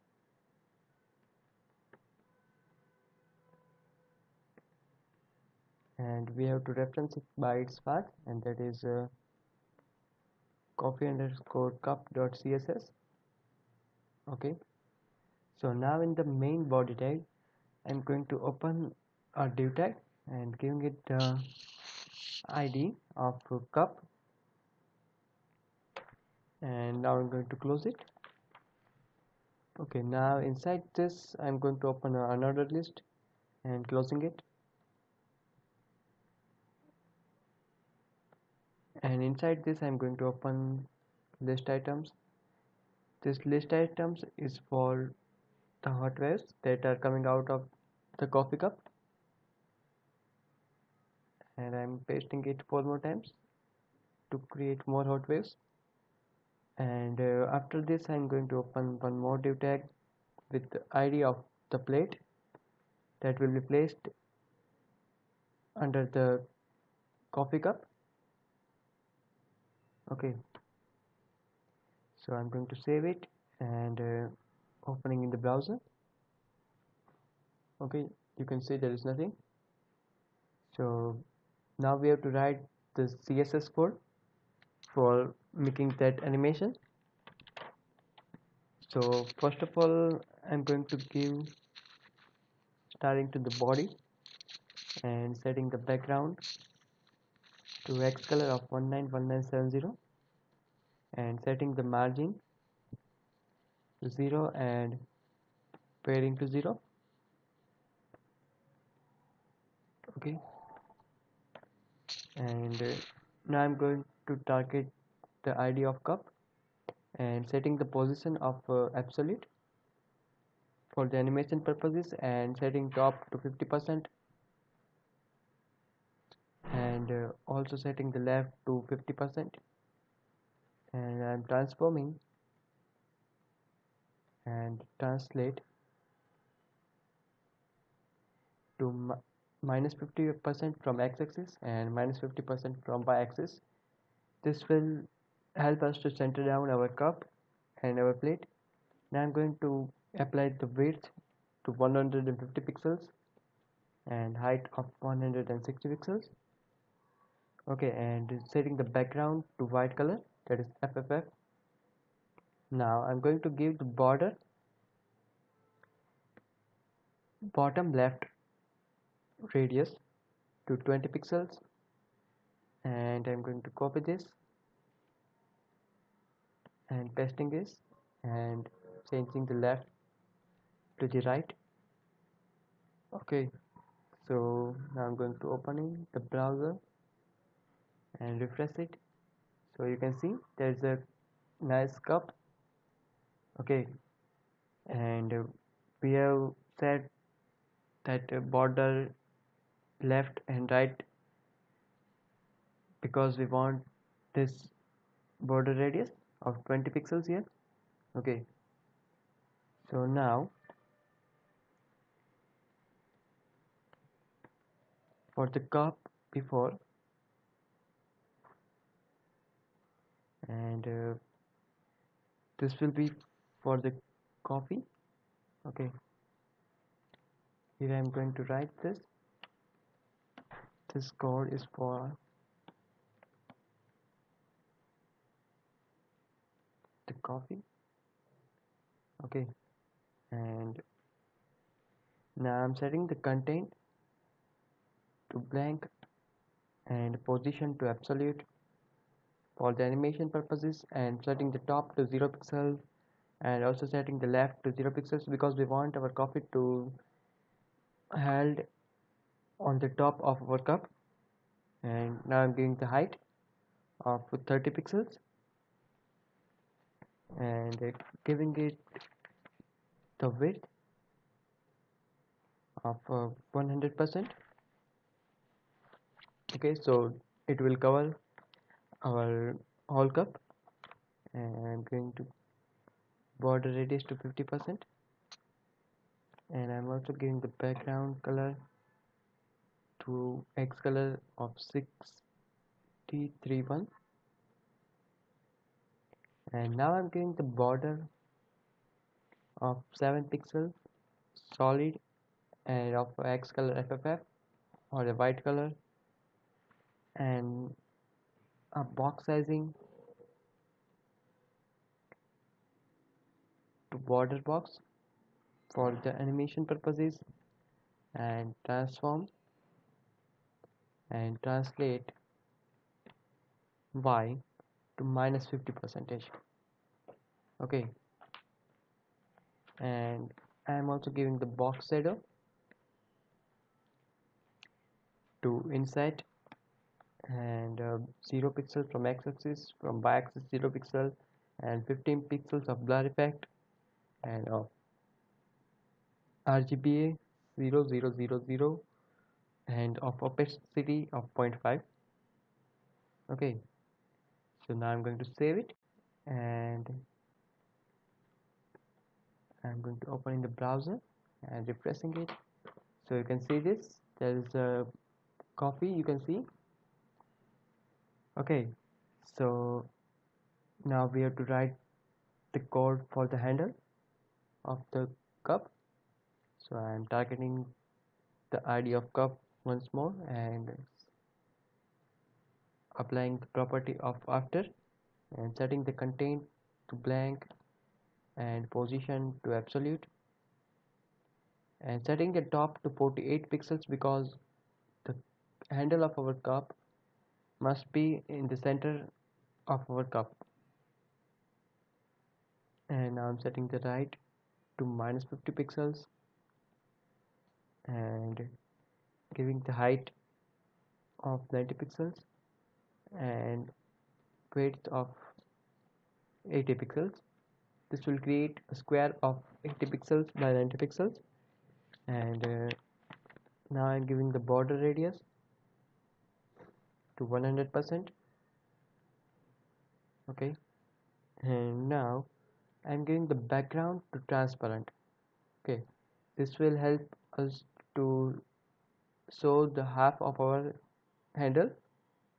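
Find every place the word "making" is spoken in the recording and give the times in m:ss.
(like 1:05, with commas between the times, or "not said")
1:25.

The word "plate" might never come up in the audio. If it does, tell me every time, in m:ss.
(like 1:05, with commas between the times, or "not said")
1:01, 2:28.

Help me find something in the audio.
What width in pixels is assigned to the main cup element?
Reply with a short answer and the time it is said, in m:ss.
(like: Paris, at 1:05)
150 pixels, at 2:31.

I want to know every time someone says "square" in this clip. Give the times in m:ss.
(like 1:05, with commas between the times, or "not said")
6:58.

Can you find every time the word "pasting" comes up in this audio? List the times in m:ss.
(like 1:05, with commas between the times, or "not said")
0:52, 2:57.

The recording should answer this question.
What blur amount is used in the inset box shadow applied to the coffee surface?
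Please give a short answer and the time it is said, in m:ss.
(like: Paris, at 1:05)
15 pixels, at 5:41.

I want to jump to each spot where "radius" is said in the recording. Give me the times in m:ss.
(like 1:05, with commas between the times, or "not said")
2:49, 3:25, 4:43, 7:04.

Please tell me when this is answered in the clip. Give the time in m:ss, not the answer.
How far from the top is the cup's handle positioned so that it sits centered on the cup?
6:32.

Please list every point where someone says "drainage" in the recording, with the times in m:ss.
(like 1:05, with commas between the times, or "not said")
not said.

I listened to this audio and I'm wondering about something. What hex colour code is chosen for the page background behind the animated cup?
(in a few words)
#191970.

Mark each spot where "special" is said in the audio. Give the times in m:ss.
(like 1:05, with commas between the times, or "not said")
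not said.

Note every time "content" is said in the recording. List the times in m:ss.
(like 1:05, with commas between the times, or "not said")
4:03, 6:25.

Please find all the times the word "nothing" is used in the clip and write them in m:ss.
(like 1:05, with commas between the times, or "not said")
1:19.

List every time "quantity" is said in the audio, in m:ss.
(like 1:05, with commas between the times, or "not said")
not said.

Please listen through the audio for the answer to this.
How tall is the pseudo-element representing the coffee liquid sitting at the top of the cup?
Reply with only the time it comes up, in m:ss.
4:24.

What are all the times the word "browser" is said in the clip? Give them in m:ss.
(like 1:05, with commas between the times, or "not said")
1:15, 3:06, 6:00.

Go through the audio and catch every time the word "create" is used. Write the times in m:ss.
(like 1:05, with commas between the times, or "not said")
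0:54, 6:58.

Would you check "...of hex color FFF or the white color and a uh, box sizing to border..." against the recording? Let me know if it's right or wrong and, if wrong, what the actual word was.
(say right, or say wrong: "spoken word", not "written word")
right.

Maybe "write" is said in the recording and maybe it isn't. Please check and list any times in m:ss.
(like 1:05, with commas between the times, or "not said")
1:22, 3:48, 6:11.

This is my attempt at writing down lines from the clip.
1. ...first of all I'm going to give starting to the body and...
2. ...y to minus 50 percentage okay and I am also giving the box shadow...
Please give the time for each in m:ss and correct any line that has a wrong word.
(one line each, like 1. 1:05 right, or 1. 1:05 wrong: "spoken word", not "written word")
1. 1:29 right
2. 5:23 right.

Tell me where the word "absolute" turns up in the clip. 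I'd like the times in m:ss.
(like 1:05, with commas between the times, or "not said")
1:58, 4:07, 6:29.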